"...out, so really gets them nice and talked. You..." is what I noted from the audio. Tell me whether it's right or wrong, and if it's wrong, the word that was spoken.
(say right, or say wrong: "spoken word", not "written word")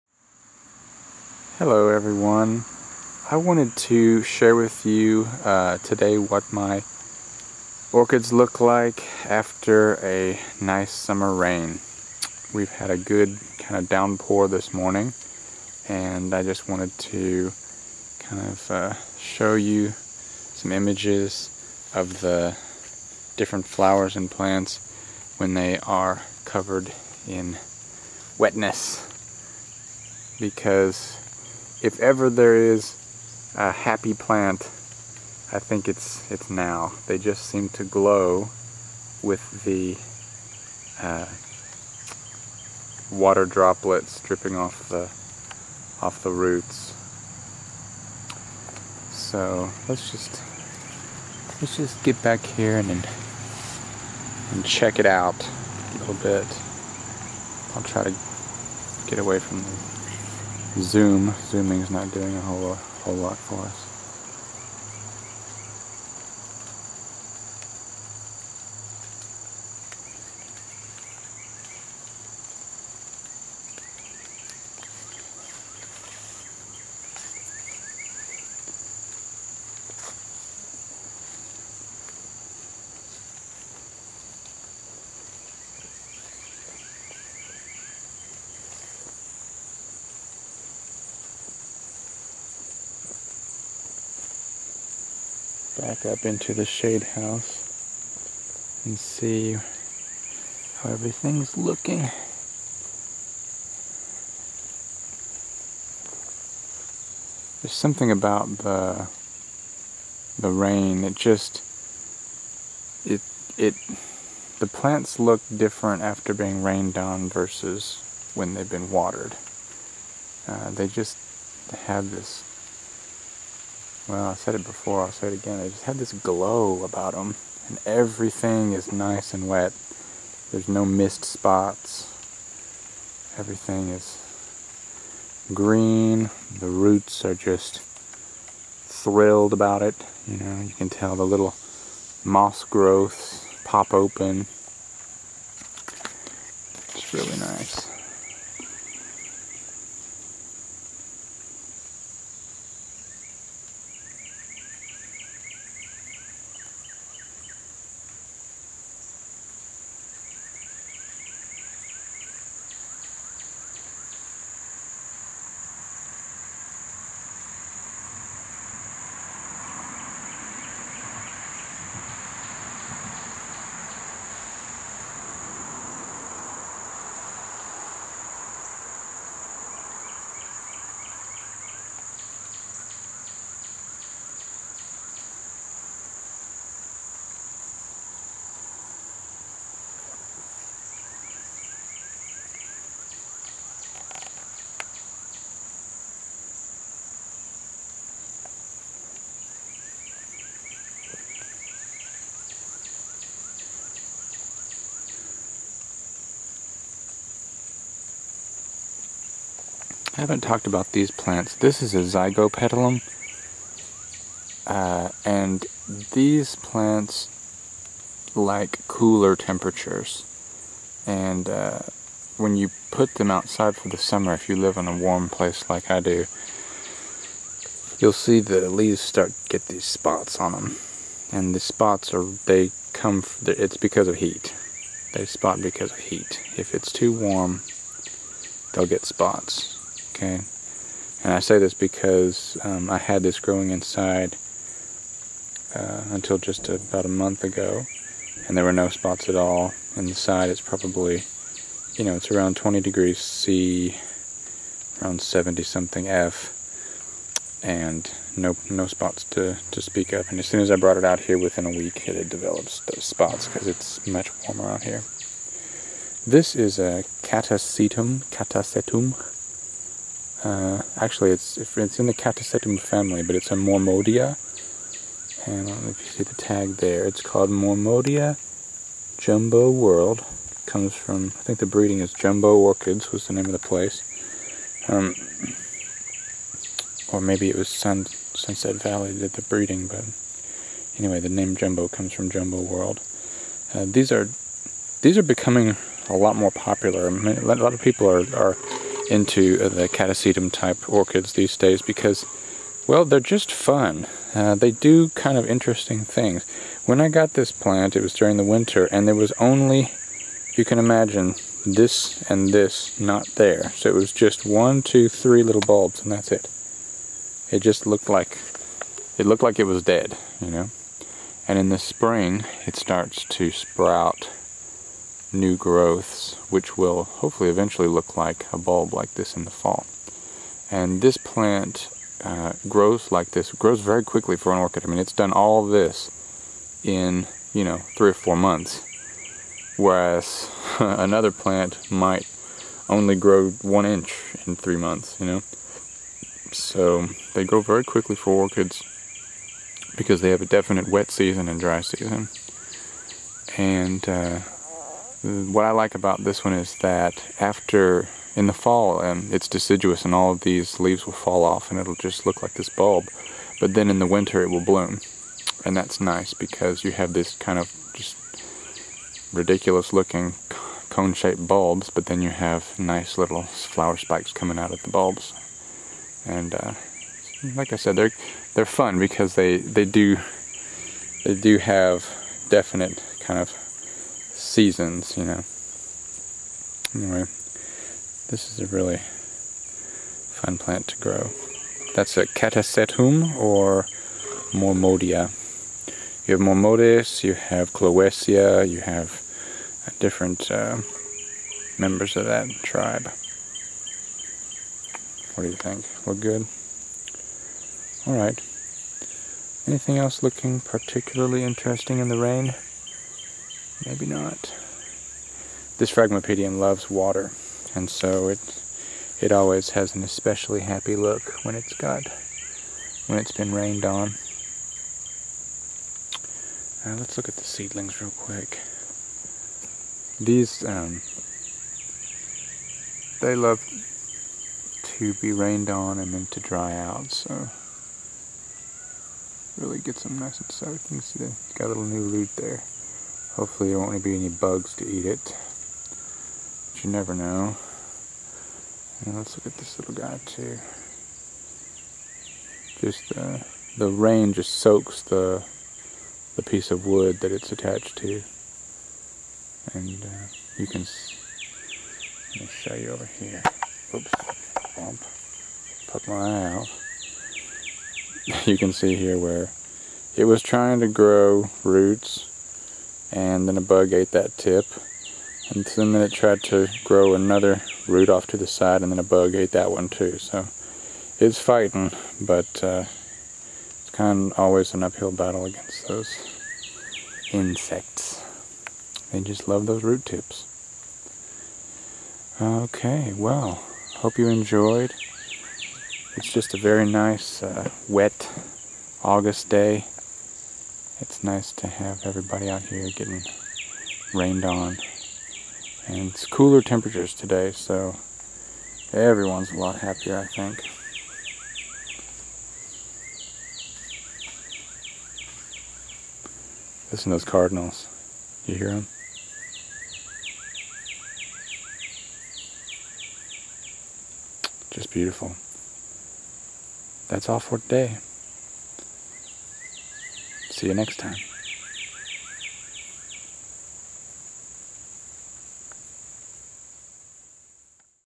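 wrong: "soaked", not "talked".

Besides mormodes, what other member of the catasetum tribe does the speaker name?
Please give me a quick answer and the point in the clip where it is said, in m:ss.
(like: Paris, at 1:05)
Clowesia, at 6:37.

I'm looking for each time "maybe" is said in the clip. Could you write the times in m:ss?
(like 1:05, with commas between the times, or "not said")
4:47, 6:53.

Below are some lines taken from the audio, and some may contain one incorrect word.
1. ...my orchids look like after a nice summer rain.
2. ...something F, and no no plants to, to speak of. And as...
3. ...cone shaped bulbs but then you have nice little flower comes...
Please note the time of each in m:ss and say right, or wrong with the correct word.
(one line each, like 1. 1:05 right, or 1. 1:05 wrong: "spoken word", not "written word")
1. 0:06 right
2. 4:15 wrong: "spots", not "plants"
3. 6:10 wrong: "spikes", not "comes".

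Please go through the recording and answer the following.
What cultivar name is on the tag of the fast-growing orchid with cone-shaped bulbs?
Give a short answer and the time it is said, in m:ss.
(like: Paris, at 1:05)
Mormodia Jumbo World, at 4:37.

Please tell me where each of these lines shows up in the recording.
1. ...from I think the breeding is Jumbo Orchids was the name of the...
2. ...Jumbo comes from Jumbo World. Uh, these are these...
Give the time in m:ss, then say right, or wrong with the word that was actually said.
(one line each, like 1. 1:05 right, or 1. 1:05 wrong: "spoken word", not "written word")
1. 4:40 right
2. 4:51 right.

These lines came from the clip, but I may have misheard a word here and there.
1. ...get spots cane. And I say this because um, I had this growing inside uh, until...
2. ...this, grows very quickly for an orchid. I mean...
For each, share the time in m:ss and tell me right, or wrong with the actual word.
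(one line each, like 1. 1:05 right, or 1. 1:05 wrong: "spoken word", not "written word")
1. 3:58 right
2. 5:33 right.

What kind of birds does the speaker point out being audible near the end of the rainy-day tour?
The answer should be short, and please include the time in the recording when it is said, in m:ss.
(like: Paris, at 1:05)
Cardinals, at 8:37.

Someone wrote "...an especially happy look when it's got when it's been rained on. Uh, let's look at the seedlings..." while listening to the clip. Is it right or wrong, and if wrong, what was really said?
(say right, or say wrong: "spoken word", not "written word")
right.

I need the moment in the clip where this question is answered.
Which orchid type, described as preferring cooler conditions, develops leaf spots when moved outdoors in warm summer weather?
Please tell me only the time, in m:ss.
3:32.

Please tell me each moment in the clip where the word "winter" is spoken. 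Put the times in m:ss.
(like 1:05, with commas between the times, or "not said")
5:08, 6:04.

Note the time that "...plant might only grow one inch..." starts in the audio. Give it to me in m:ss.
5:41.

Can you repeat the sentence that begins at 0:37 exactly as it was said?
They just seem to glow with the uh, water droplets dripping off the off the roots.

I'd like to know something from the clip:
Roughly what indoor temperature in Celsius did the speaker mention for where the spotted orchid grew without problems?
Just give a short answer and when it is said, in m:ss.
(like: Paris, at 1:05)
20 degrees C, at 4:12.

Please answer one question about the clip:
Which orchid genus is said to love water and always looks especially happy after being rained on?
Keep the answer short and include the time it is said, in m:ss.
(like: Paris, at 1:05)
Phragmipedium, at 6:55.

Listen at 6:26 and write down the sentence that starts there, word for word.
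Anyway, this is a really fun plant to grow.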